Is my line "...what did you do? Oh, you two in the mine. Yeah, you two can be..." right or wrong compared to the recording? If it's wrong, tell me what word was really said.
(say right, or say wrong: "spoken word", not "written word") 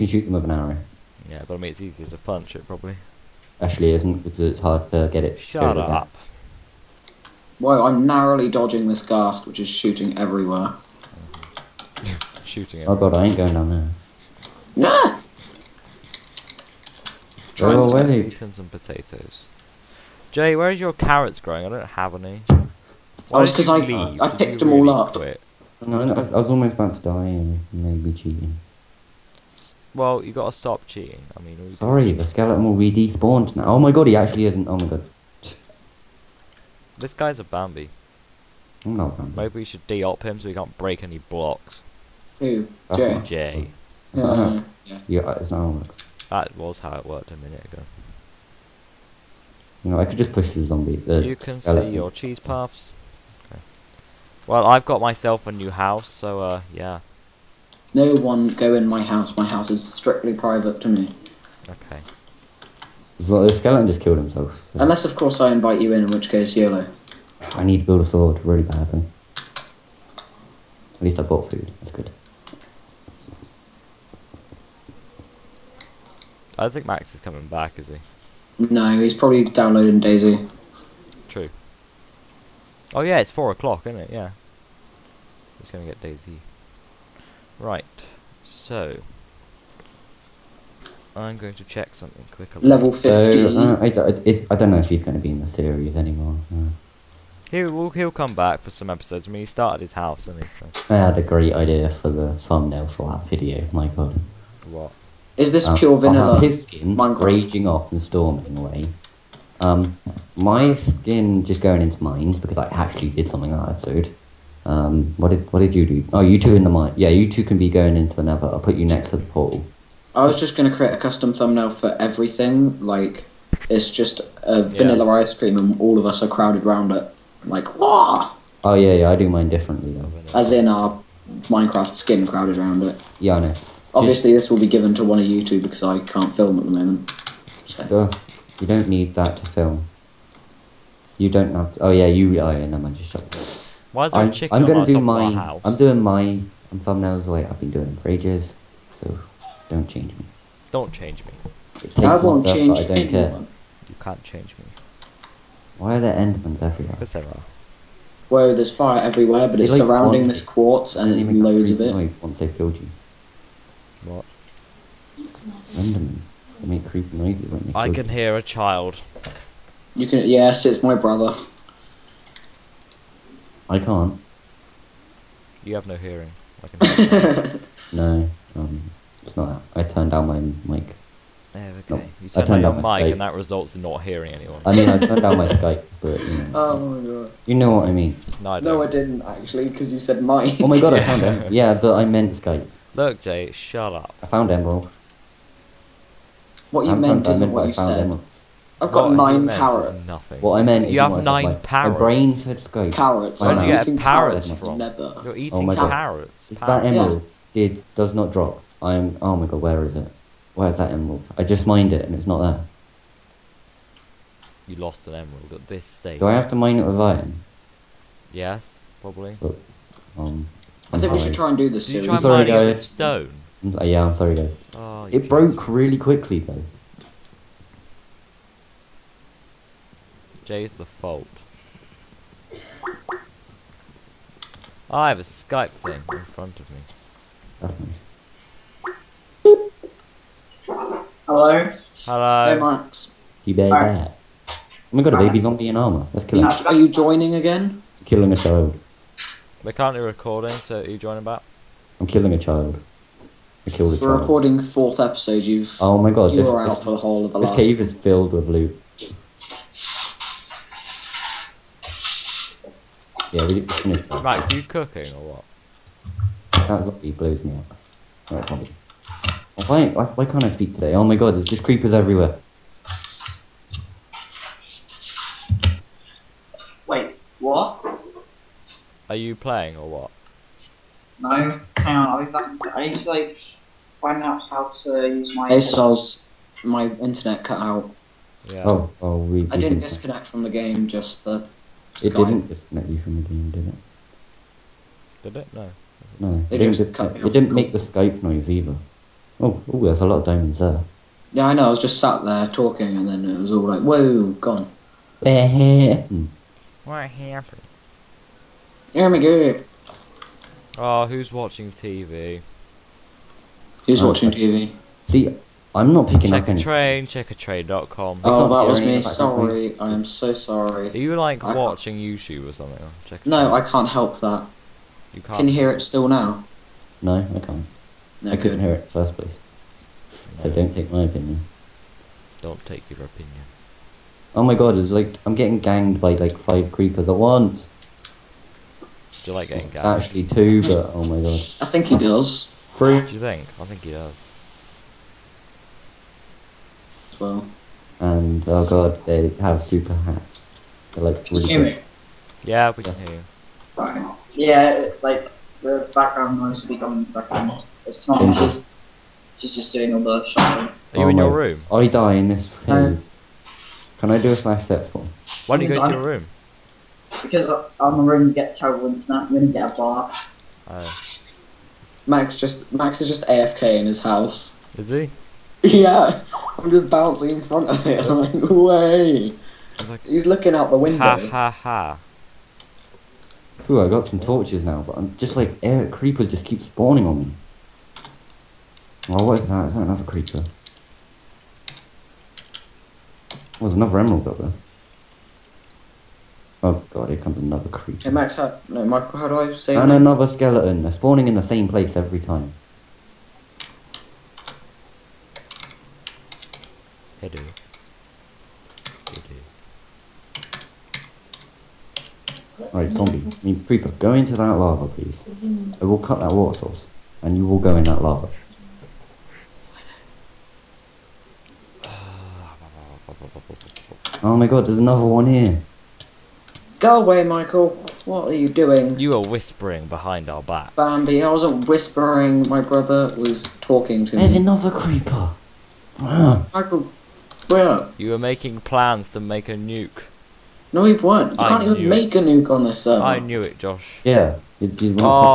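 right.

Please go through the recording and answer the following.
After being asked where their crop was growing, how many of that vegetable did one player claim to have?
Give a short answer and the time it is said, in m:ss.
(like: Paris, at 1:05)
9, at 3:19.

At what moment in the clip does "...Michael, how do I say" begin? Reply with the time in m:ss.
6:38.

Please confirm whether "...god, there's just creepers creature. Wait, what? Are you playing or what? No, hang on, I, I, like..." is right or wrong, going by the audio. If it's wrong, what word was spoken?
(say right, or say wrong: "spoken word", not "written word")
wrong: "everywhere", not "creature".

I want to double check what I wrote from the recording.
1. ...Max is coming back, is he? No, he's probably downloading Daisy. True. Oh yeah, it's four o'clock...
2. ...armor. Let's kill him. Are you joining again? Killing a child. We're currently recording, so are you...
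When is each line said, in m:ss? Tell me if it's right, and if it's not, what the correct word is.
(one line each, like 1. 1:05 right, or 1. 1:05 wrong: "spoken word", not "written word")
1. 1:16 right
2. 4:05 right.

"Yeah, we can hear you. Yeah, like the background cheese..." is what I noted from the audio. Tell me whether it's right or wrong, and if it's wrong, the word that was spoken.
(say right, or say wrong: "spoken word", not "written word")
wrong: "noise", not "cheese".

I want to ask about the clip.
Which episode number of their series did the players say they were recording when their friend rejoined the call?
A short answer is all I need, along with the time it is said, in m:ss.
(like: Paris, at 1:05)
4, at 4:14.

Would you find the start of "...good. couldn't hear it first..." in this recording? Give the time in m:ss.
5:28.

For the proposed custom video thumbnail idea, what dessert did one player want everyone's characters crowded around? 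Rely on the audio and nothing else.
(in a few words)
Ice cream.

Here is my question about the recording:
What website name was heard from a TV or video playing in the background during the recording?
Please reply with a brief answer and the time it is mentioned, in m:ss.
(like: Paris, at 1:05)
Checkatrain.com, at 5:17.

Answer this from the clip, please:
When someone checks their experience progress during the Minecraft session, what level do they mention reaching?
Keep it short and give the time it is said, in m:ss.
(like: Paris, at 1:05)
50, at 1:32.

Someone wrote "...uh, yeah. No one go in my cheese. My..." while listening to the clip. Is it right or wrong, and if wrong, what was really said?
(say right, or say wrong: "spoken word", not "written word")
wrong: "house", not "cheese".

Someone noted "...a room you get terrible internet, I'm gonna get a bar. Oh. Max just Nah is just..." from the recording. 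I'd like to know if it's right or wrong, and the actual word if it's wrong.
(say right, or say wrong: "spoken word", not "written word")
wrong: "Max", not "Nah".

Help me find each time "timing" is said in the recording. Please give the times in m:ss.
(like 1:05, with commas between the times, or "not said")
not said.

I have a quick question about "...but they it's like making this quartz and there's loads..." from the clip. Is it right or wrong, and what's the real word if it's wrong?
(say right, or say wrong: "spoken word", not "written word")
wrong: "surrounding", not "making".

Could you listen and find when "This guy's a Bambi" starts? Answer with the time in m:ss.
0:36.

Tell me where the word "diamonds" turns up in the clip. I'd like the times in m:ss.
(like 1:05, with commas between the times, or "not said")
5:00.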